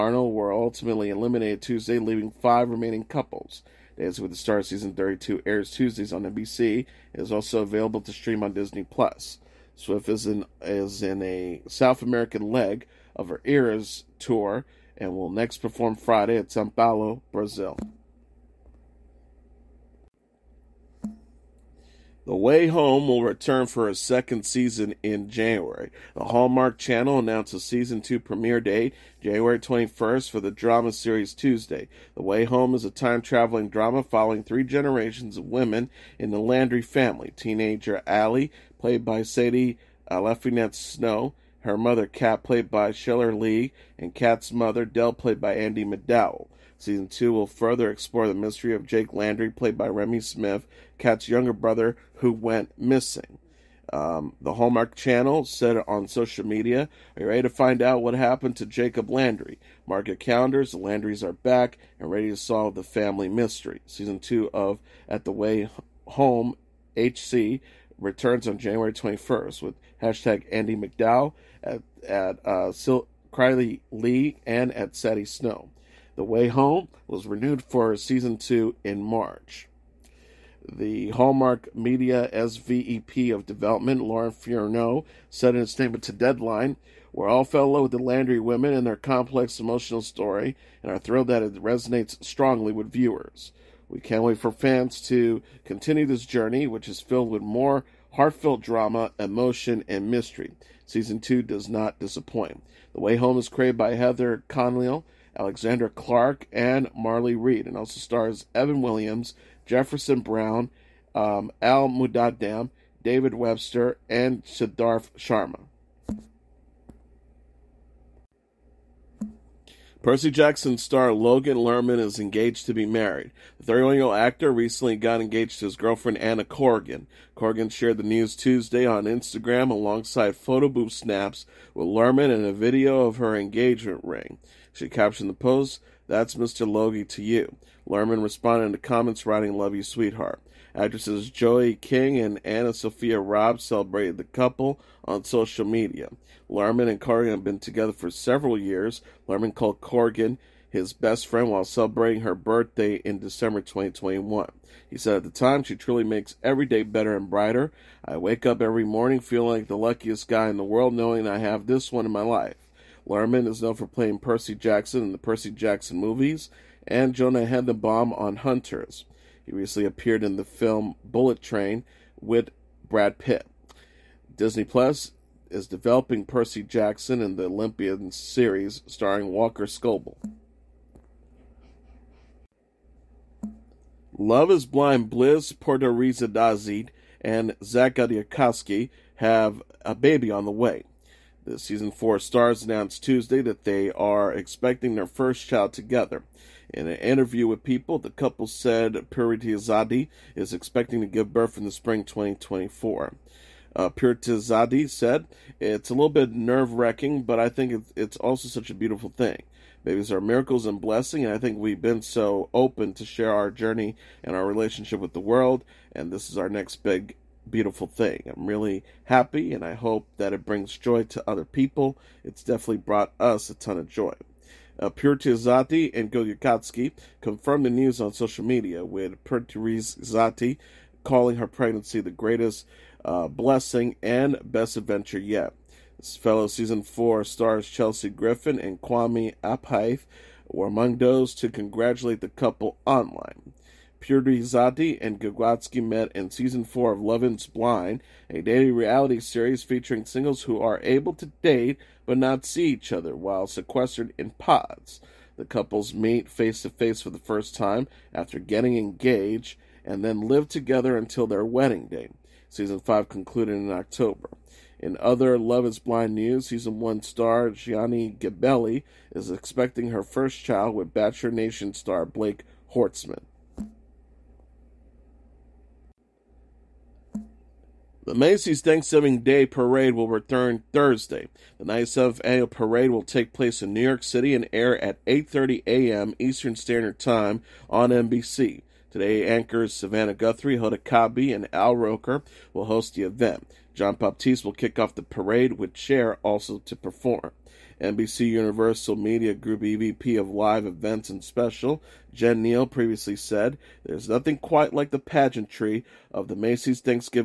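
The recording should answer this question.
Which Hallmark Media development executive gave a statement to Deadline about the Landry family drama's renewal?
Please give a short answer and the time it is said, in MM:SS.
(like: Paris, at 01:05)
Lauren Furneaux, at 01:24.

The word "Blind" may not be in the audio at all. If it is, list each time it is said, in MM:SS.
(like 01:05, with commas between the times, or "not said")
03:04, 04:07, 04:25.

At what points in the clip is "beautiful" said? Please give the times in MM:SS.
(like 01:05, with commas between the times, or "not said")
03:28, 03:37.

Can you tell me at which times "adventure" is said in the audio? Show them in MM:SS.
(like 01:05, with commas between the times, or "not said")
03:54.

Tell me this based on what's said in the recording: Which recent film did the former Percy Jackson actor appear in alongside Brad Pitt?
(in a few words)
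Bullet Train.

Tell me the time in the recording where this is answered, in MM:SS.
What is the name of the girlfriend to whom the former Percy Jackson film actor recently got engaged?
02:06.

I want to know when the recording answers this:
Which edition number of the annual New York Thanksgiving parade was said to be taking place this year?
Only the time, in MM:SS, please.
04:41.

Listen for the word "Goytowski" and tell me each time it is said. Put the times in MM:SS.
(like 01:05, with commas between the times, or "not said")
03:46, 04:05.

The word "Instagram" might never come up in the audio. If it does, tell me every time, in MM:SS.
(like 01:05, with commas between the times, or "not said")
02:09.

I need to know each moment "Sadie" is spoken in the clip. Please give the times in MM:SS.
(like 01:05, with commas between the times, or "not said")
00:39, 01:14.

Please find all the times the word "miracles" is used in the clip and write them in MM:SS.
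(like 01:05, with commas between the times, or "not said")
03:30.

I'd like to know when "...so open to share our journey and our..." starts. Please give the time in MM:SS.
03:32.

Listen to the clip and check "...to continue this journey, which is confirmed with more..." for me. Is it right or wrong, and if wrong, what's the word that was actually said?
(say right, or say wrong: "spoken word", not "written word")
wrong: "filled", not "confirmed".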